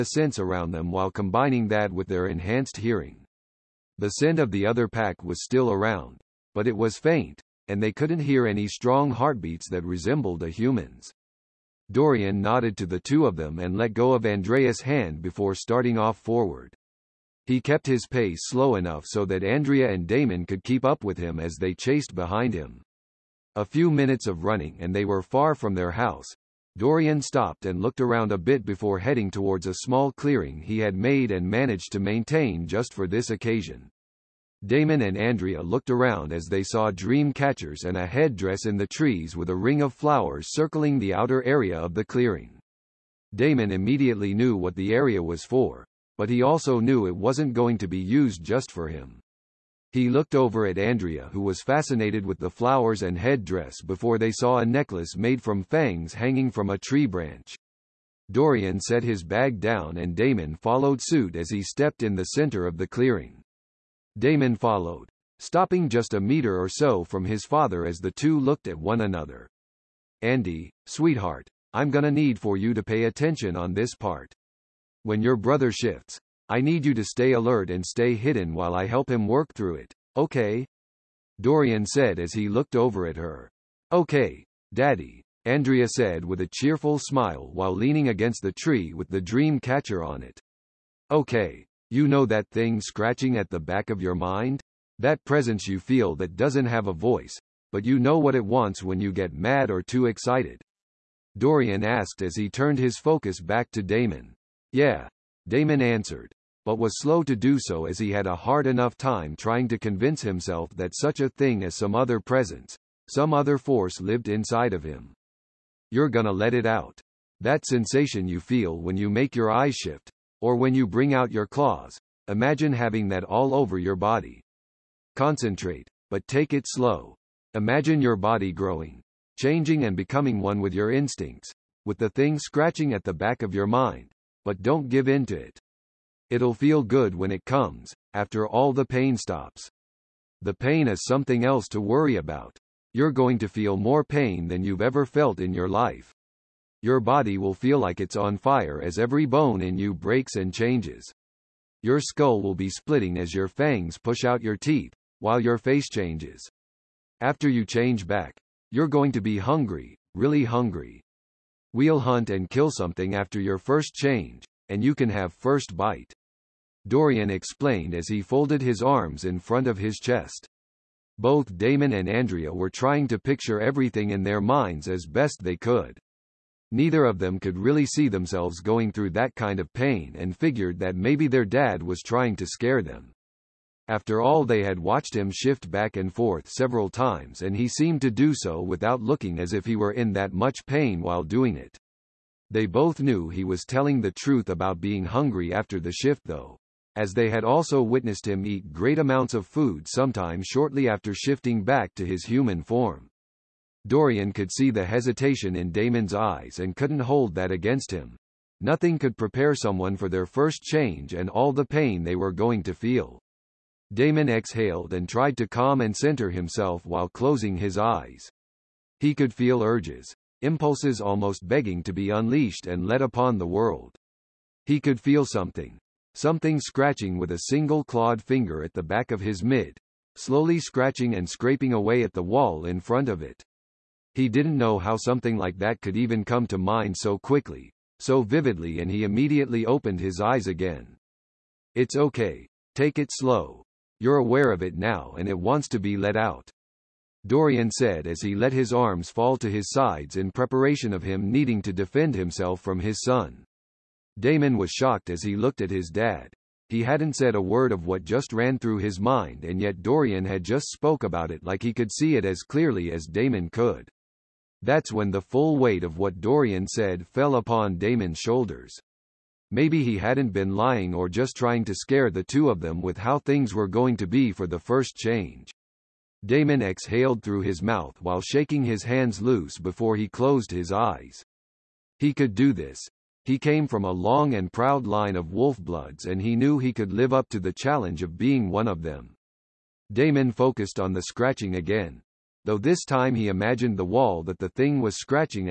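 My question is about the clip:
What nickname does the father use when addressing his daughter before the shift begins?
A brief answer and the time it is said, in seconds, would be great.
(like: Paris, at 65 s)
Andy, at 70 s.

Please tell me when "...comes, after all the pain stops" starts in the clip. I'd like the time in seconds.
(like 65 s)
137 s.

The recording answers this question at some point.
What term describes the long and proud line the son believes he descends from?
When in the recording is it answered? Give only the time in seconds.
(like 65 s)
285 s.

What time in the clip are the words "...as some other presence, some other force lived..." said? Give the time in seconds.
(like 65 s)
111 s.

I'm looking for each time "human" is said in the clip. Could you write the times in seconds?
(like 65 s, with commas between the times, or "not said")
10 s, 202 s.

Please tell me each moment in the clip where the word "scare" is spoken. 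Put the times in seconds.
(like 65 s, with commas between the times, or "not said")
182 s, 271 s.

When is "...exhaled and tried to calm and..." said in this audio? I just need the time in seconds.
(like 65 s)
214 s.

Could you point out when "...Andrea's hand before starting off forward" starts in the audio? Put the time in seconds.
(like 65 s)
14 s.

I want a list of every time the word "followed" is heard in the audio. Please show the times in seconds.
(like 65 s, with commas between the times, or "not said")
60 s, 64 s.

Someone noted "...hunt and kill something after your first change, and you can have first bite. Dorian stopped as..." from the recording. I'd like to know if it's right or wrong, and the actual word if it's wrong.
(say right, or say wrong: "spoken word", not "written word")
wrong: "explained", not "stopped".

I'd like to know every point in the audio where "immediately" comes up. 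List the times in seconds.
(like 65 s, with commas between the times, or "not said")
43 s, 239 s.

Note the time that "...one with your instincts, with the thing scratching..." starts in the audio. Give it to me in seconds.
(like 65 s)
130 s.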